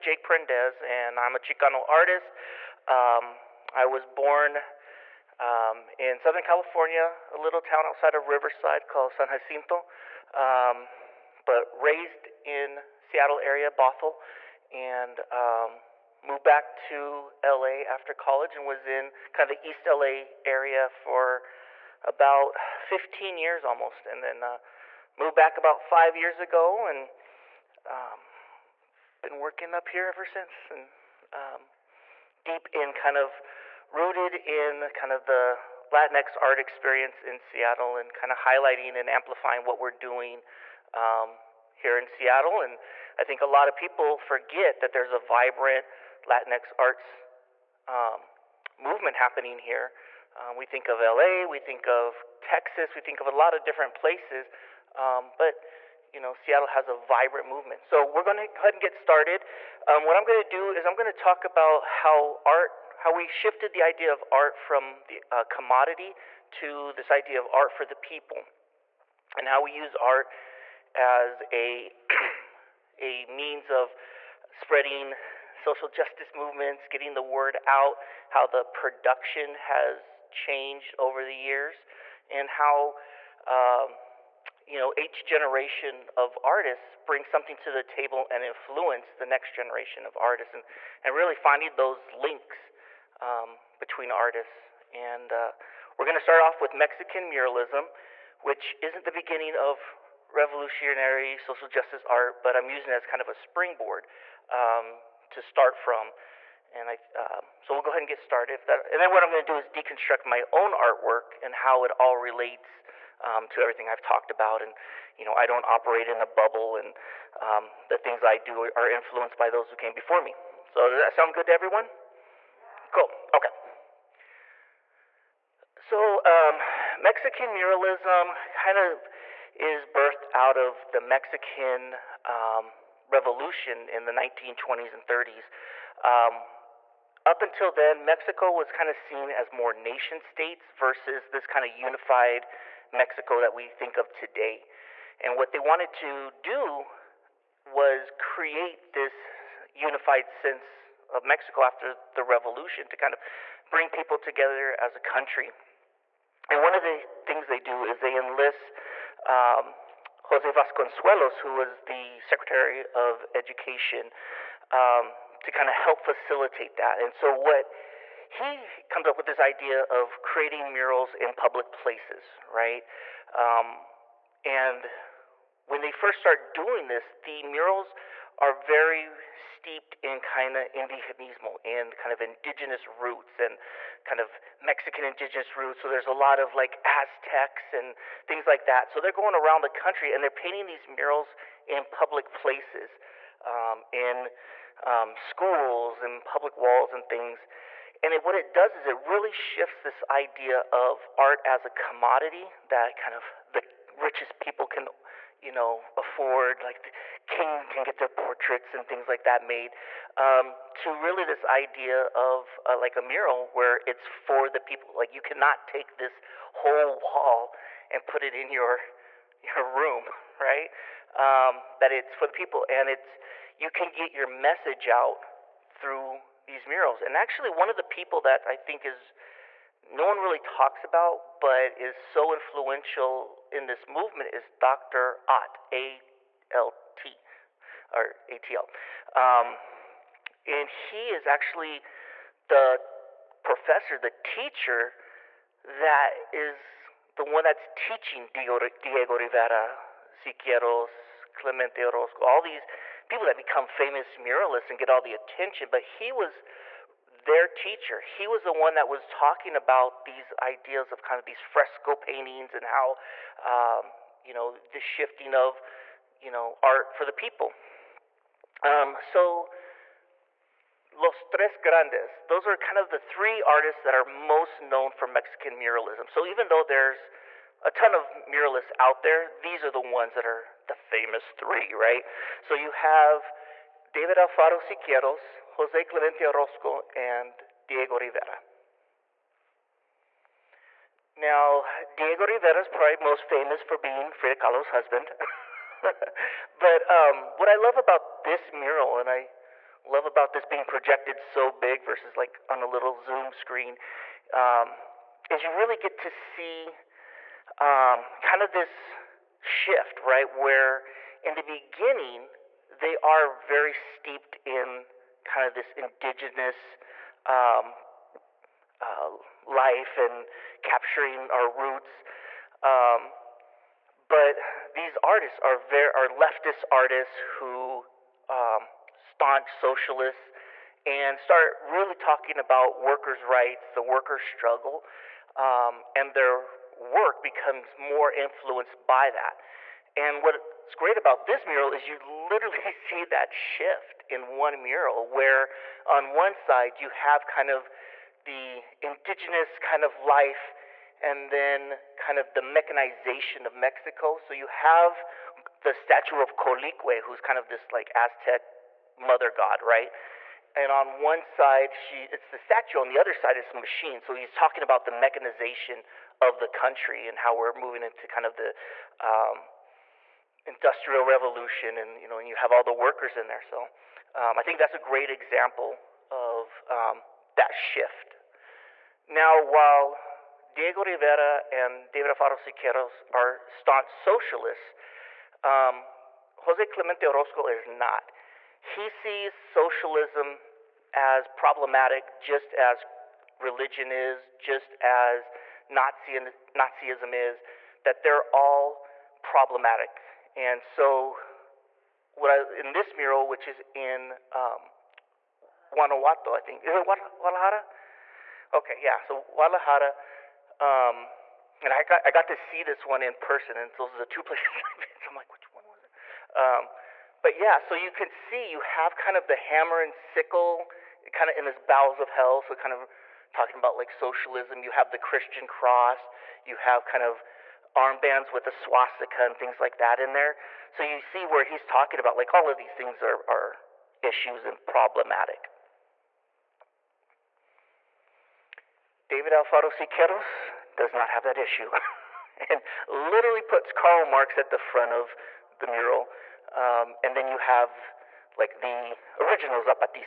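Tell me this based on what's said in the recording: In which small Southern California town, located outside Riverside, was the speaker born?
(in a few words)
San Jacinto.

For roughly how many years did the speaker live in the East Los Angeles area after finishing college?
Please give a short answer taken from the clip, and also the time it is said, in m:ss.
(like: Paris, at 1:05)
15, at 0:22.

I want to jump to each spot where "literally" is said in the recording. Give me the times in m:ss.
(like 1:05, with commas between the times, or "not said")
5:41, 7:22.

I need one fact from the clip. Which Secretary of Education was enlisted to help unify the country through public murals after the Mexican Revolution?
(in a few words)
Jose Vasconcelos.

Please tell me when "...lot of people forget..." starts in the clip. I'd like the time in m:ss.
0:43.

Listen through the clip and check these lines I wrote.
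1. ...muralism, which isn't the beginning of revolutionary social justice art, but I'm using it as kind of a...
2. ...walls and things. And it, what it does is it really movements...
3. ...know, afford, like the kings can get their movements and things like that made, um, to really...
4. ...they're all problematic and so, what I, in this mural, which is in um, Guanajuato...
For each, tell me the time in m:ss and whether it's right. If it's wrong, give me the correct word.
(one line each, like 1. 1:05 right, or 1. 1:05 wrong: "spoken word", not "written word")
1. 1:37 right
2. 3:16 wrong: "shifts", not "movements"
3. 3:25 wrong: "portraits", not "movements"
4. 6:38 right.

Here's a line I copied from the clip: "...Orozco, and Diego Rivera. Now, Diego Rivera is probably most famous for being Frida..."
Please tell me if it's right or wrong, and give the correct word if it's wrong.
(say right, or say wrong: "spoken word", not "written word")
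right.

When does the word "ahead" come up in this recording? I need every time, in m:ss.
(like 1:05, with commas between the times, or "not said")
0:58, 1:47.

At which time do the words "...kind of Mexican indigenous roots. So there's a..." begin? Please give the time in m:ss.
3:04.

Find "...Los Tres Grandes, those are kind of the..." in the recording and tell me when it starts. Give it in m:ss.
4:30.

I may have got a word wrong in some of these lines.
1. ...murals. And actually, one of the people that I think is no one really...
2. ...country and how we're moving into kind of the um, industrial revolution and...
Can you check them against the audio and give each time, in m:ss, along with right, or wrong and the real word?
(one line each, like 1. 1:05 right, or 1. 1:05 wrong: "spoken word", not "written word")
1. 3:46 right
2. 6:06 right.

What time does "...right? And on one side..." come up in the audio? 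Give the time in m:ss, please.
5:59.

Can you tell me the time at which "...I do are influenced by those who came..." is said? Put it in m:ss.
1:58.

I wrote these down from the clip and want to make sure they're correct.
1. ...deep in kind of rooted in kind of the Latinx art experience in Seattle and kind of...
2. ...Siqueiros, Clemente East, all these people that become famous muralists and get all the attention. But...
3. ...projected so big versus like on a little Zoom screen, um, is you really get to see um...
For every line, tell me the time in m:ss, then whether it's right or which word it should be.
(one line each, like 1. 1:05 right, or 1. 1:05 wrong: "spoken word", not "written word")
1. 0:32 right
2. 4:10 wrong: "Orozco", not "East"
3. 5:00 right.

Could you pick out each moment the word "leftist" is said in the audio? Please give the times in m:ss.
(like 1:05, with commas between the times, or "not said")
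5:26.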